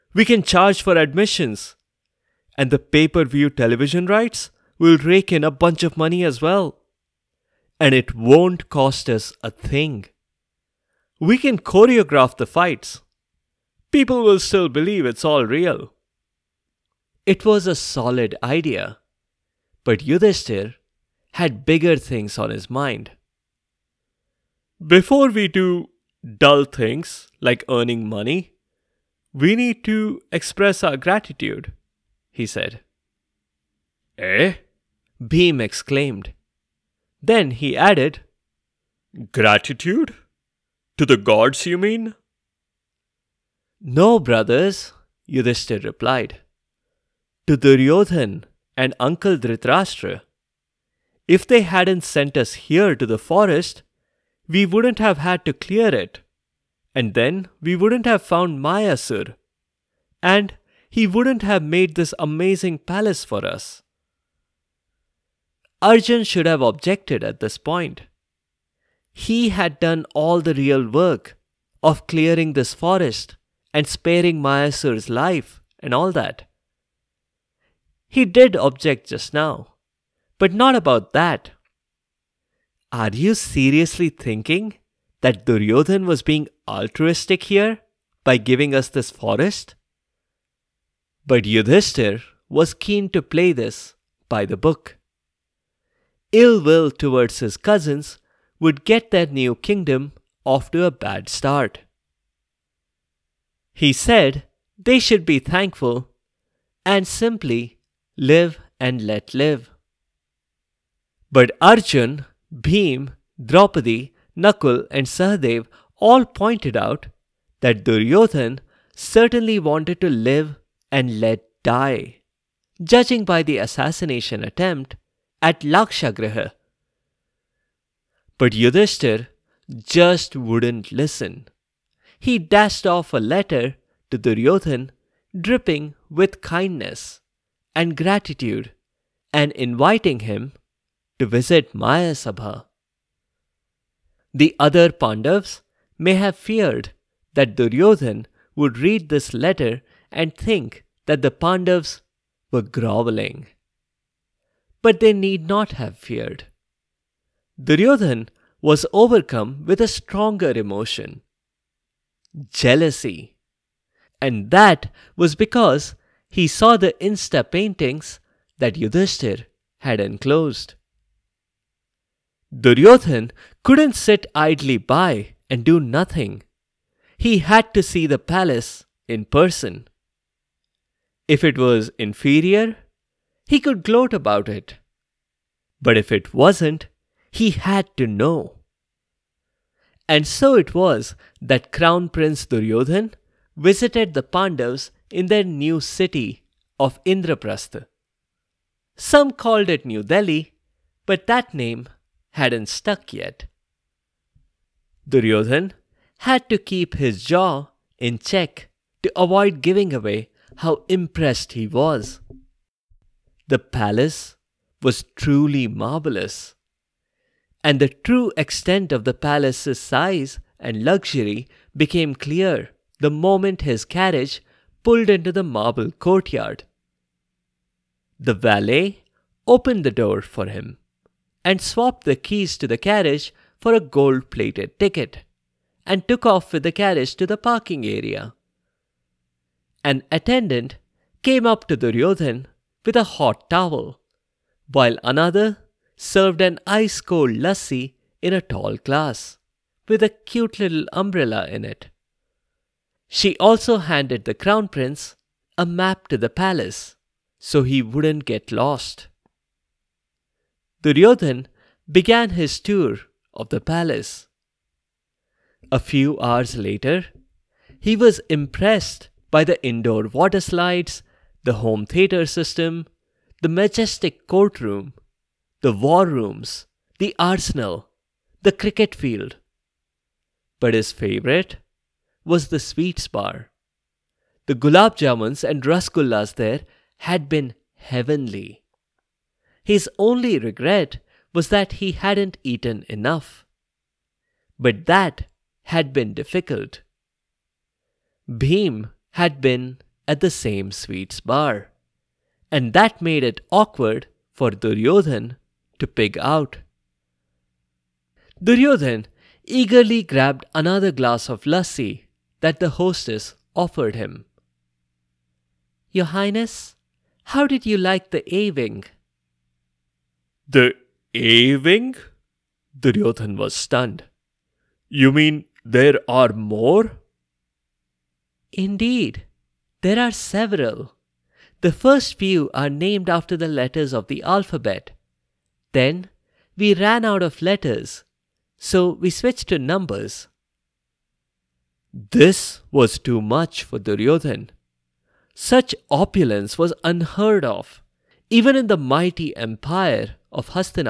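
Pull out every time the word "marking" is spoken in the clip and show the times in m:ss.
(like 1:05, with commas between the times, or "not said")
not said.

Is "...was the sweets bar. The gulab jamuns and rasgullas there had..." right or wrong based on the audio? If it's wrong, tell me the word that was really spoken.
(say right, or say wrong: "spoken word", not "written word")
right.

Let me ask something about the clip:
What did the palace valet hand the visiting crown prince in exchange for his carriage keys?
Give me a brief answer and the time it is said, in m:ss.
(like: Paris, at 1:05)
A gold plated ticket, at 3:53.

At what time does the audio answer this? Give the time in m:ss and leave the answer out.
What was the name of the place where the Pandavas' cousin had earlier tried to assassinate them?
2:05.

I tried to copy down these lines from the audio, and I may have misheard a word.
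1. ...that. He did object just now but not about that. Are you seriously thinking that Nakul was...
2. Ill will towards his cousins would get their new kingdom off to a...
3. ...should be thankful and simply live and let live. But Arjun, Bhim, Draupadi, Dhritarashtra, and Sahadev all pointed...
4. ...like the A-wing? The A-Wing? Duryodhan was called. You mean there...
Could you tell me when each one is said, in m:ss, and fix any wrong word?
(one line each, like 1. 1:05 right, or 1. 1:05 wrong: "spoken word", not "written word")
1. 1:16 wrong: "Duryodhan", not "Nakul"
2. 1:36 right
3. 1:44 wrong: "Nakul", not "Dhritarashtra"
4. 5:17 wrong: "stunned", not "called".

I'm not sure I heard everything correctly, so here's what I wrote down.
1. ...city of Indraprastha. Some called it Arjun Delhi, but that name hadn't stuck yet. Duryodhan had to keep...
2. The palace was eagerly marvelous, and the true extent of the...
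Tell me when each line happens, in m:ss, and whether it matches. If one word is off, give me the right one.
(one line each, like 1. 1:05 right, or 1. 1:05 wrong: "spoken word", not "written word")
1. 3:15 wrong: "New", not "Arjun"
2. 3:33 wrong: "truly", not "eagerly".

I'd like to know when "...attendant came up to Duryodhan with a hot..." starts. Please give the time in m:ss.
4:00.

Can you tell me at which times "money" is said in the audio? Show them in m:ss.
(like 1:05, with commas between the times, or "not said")
0:05, 0:28.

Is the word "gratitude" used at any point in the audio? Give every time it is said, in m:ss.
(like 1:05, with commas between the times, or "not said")
0:30, 0:39, 2:17.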